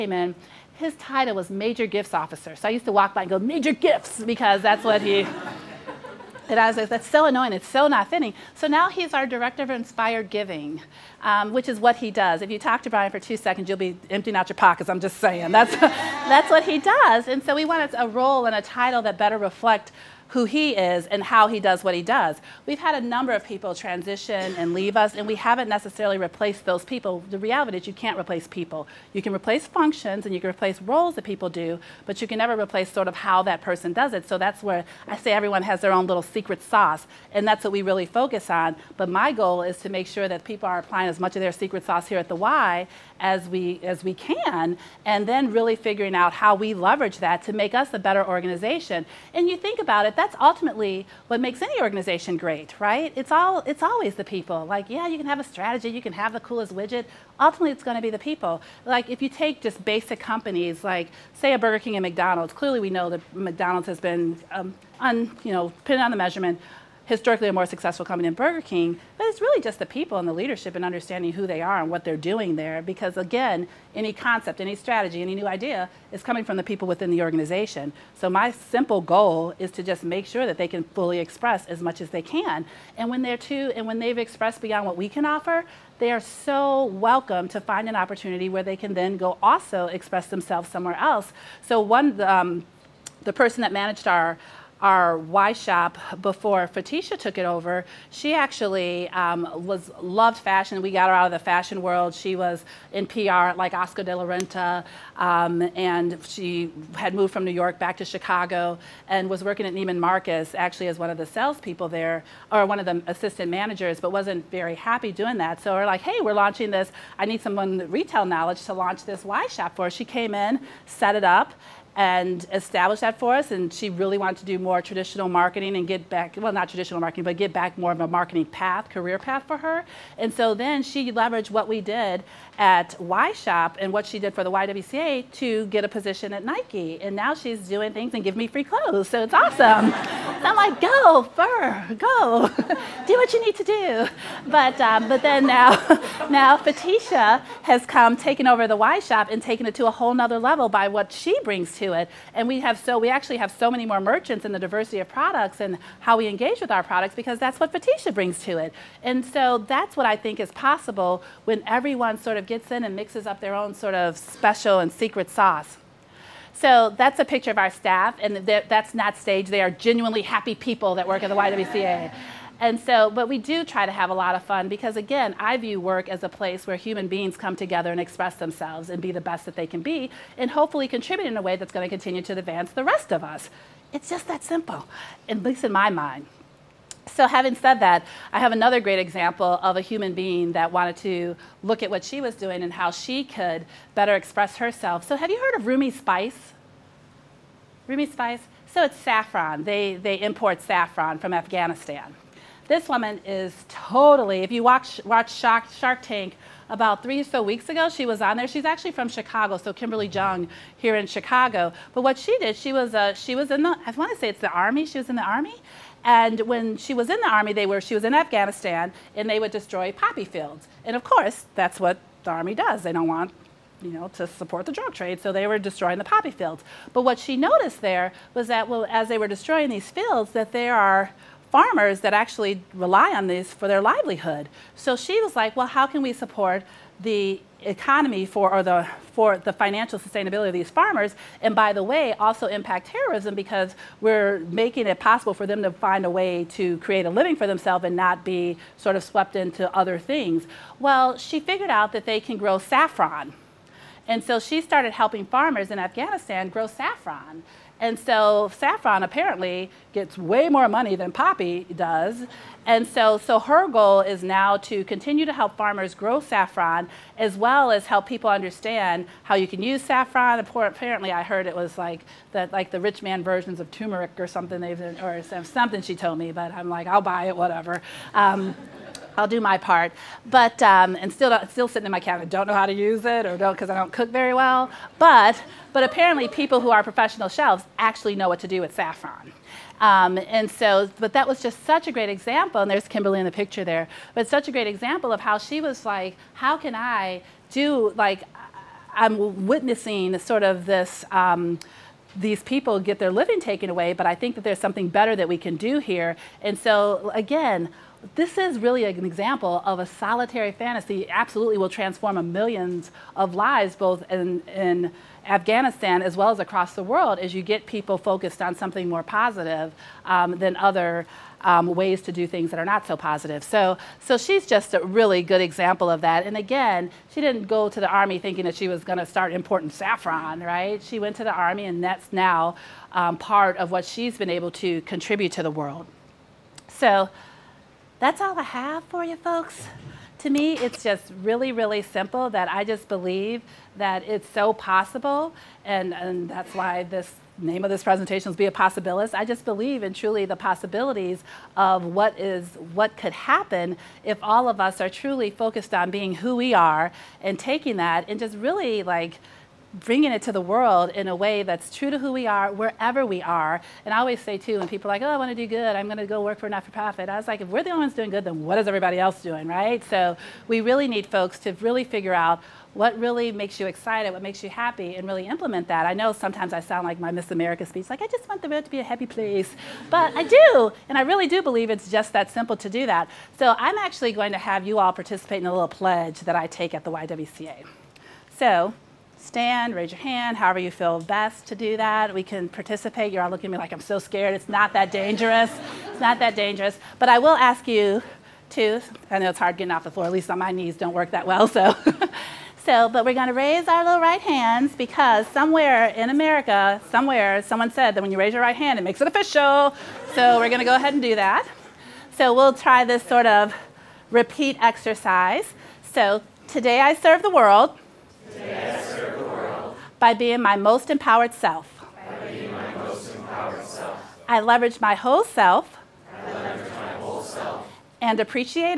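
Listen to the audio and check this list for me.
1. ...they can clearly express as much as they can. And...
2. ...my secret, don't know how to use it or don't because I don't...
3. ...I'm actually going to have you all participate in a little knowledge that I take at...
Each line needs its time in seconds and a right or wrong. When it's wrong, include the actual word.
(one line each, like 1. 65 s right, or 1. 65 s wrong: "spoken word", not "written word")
1. 80 s wrong: "fully", not "clearly"
2. 281 s wrong: "cabinet", not "secret"
3. 383 s wrong: "pledge", not "knowledge".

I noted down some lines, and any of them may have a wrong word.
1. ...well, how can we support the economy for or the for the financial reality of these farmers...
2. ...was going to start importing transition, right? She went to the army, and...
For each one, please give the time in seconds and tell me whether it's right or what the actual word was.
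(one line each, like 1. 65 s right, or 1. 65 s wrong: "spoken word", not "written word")
1. 235 s wrong: "sustainability", not "reality"
2. 328 s wrong: "saffron", not "transition".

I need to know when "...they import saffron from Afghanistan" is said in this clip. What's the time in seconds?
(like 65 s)
199 s.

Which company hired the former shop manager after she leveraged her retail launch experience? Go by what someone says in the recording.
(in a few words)
Nike.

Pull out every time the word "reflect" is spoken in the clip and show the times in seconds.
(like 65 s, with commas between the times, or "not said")
19 s.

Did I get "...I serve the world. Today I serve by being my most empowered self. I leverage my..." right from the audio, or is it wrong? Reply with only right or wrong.
right.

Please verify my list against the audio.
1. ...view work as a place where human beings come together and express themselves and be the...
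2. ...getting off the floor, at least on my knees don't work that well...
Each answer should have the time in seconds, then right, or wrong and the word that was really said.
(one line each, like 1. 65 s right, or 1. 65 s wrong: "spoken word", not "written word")
1. 175 s right
2. 399 s right.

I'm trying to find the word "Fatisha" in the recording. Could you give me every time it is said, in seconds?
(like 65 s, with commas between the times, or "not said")
96 s, 146 s, 157 s.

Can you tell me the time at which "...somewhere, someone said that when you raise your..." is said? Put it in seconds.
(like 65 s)
406 s.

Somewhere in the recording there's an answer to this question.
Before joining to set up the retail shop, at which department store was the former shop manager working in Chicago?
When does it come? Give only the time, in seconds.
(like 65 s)
109 s.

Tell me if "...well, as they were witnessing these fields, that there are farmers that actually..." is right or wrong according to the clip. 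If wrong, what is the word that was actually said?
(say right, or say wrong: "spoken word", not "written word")
wrong: "destroying", not "witnessing".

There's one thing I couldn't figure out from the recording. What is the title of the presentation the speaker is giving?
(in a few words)
Be a Possibilist.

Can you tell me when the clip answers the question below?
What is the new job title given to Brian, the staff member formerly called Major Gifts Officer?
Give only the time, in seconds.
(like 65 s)
9 s.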